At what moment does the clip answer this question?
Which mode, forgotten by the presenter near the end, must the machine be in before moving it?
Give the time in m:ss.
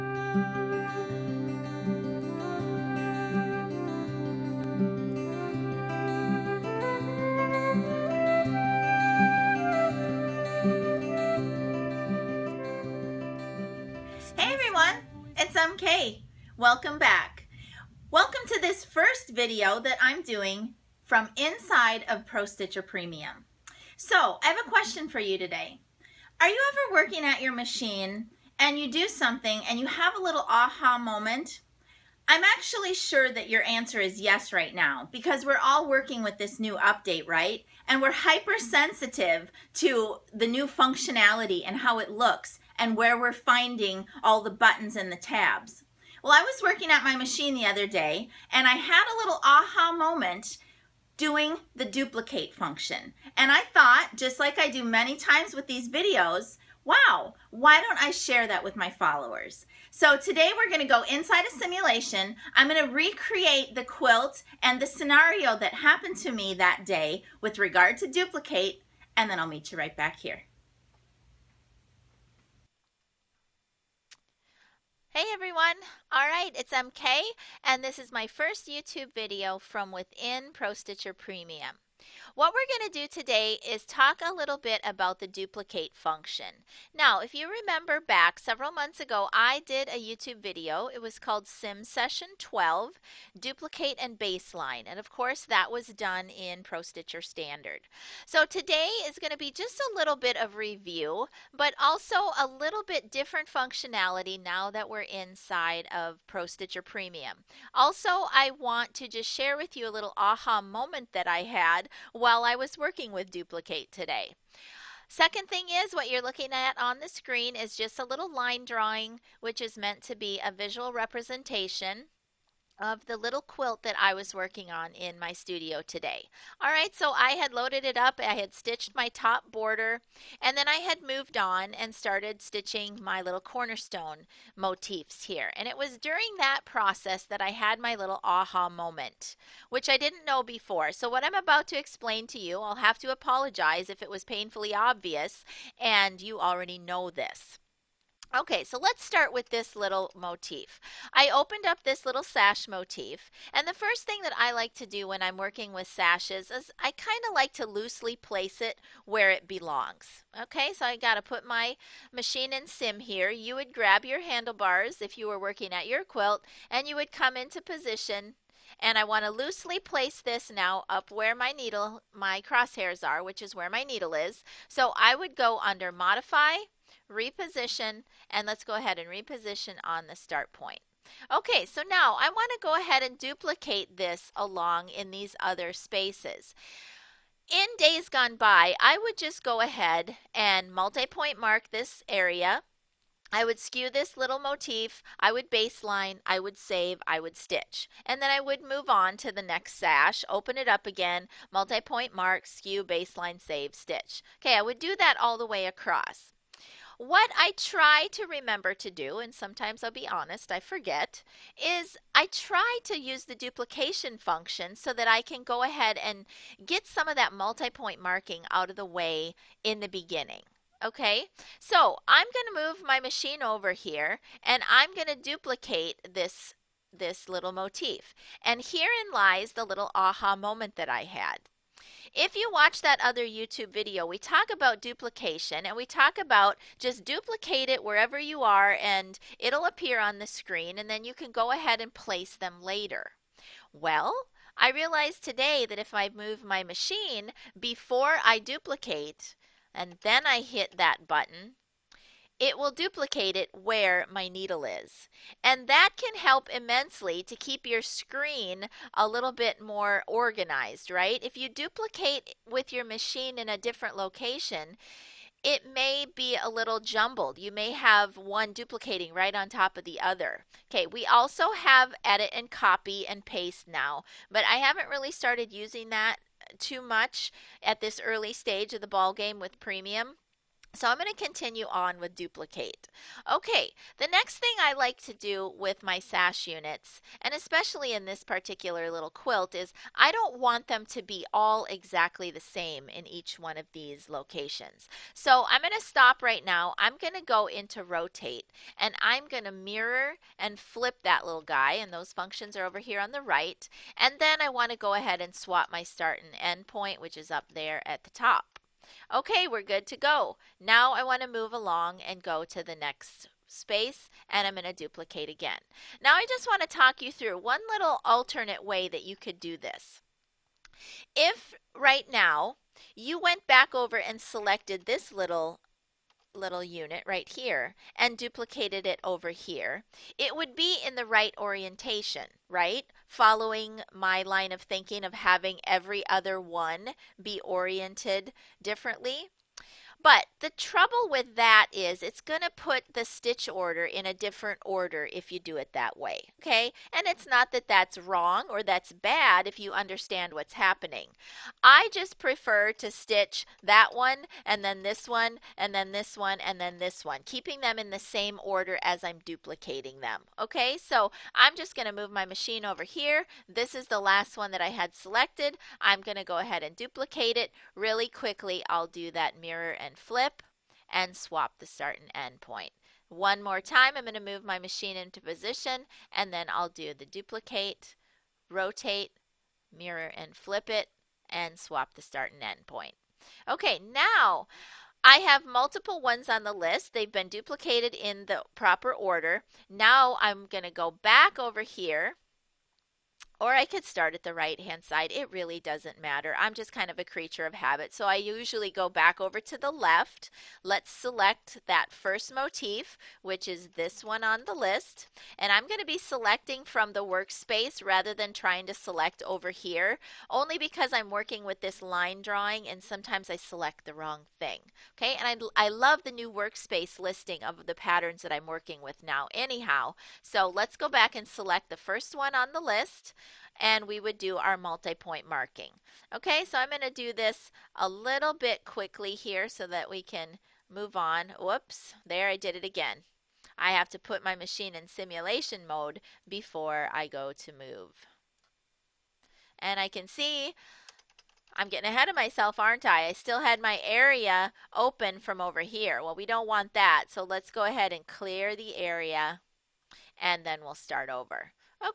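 7:14.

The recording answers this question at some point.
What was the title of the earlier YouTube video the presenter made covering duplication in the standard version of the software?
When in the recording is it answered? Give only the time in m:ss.
1:31.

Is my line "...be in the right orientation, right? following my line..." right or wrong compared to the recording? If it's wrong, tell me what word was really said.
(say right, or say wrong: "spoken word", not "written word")
right.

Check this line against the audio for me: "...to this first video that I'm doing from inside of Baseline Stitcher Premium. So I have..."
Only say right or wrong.
wrong.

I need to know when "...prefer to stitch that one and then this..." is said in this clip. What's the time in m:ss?
5:52.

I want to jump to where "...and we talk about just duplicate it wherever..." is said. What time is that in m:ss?
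3:55.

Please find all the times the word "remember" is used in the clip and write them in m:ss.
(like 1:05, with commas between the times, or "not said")
1:27, 3:28.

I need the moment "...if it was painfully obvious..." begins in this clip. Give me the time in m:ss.
2:23.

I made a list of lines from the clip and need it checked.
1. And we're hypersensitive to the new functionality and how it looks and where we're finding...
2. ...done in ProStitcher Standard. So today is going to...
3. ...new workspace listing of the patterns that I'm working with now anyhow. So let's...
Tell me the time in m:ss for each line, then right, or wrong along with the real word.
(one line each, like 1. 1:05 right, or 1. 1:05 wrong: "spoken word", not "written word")
1. 0:37 right
2. 1:35 right
3. 6:56 right.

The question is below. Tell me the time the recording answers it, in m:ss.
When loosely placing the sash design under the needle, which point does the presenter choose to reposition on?
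3:00.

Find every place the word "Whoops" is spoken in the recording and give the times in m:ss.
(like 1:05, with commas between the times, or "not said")
7:11.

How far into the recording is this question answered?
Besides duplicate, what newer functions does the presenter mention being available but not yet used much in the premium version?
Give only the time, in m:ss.
4:32.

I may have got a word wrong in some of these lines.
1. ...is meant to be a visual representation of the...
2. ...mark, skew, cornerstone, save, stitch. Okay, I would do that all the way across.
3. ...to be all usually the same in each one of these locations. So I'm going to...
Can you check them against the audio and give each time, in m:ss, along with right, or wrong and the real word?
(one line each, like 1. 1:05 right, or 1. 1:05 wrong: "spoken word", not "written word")
1. 1:59 right
2. 3:22 wrong: "baseline", not "cornerstone"
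3. 4:50 wrong: "exactly", not "usually".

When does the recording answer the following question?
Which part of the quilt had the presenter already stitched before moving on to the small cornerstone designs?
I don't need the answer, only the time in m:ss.
2:09.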